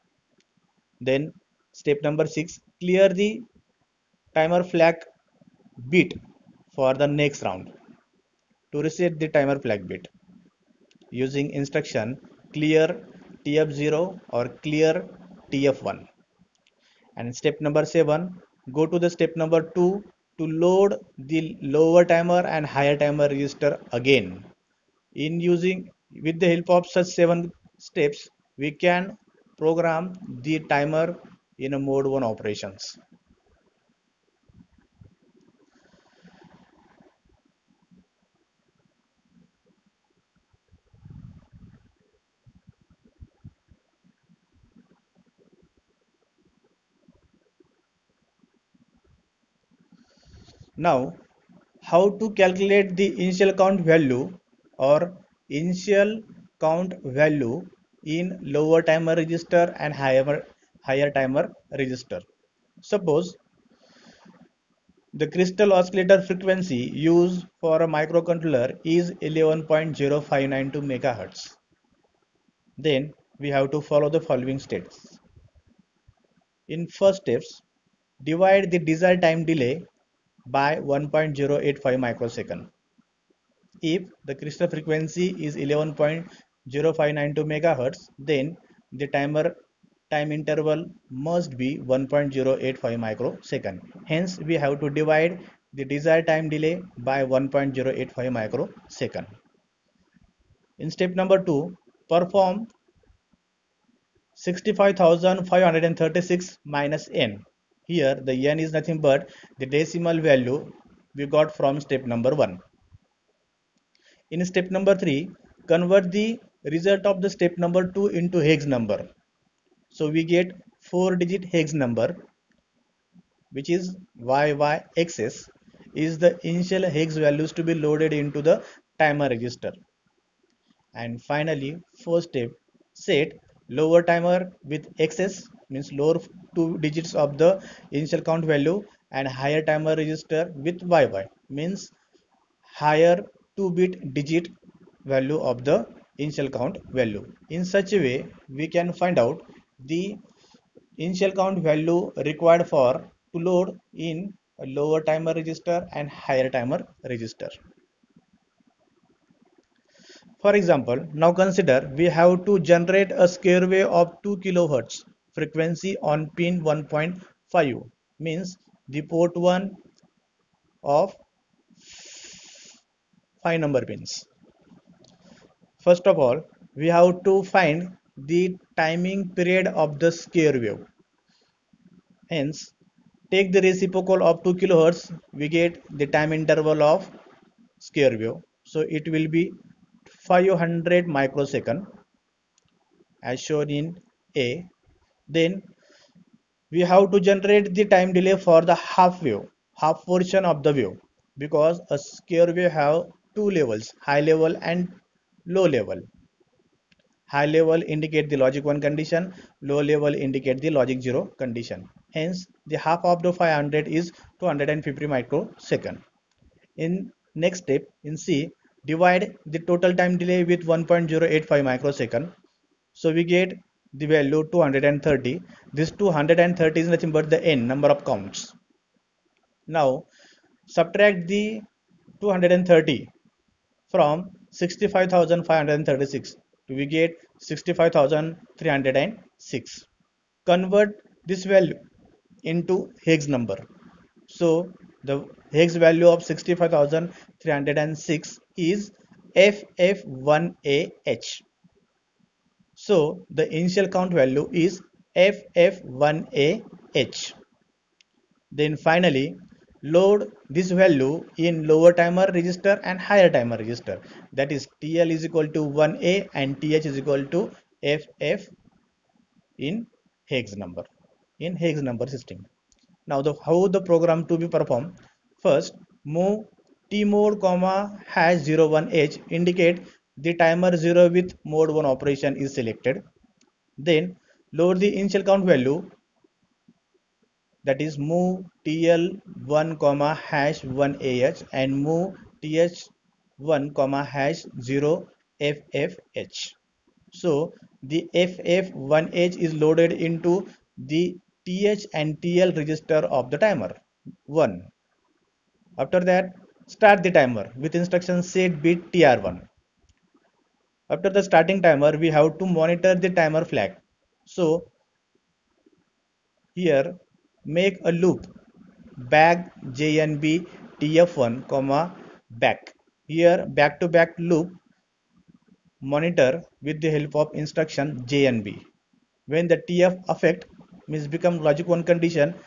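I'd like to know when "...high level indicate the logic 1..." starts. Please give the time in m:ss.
3:27.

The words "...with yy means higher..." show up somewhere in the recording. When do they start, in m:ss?
2:20.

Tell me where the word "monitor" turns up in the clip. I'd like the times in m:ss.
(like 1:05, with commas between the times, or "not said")
5:12, 5:25.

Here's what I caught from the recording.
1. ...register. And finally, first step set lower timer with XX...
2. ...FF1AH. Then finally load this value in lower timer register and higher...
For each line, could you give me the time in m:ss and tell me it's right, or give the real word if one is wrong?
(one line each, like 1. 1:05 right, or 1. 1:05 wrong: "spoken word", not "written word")
1. 2:09 right
2. 4:15 right.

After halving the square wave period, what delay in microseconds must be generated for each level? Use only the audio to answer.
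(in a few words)
250 microseconds.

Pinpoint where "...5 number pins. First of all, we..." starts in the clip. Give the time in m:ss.
2:53.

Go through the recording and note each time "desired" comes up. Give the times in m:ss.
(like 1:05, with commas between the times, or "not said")
1:18, 1:35.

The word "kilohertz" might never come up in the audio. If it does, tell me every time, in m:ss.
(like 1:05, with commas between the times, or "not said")
2:44, 3:04.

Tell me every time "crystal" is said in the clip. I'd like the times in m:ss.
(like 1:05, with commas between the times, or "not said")
1:05, 1:24.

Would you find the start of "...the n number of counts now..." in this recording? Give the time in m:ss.
3:47.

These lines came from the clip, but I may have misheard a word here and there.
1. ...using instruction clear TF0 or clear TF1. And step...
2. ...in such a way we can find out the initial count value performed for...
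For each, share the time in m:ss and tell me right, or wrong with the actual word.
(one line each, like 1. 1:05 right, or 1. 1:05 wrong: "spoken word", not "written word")
1. 0:11 right
2. 2:27 wrong: "required", not "performed".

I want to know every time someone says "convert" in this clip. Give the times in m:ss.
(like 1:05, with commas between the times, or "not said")
1:55, 4:00.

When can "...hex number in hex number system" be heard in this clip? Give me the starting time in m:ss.
4:30.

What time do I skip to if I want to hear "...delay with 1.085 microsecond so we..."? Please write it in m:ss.
3:40.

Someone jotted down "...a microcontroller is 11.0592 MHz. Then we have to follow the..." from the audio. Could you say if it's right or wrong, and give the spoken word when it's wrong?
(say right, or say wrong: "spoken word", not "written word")
right.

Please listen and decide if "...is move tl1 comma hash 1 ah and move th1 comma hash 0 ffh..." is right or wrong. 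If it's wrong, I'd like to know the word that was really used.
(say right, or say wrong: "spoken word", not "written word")
right.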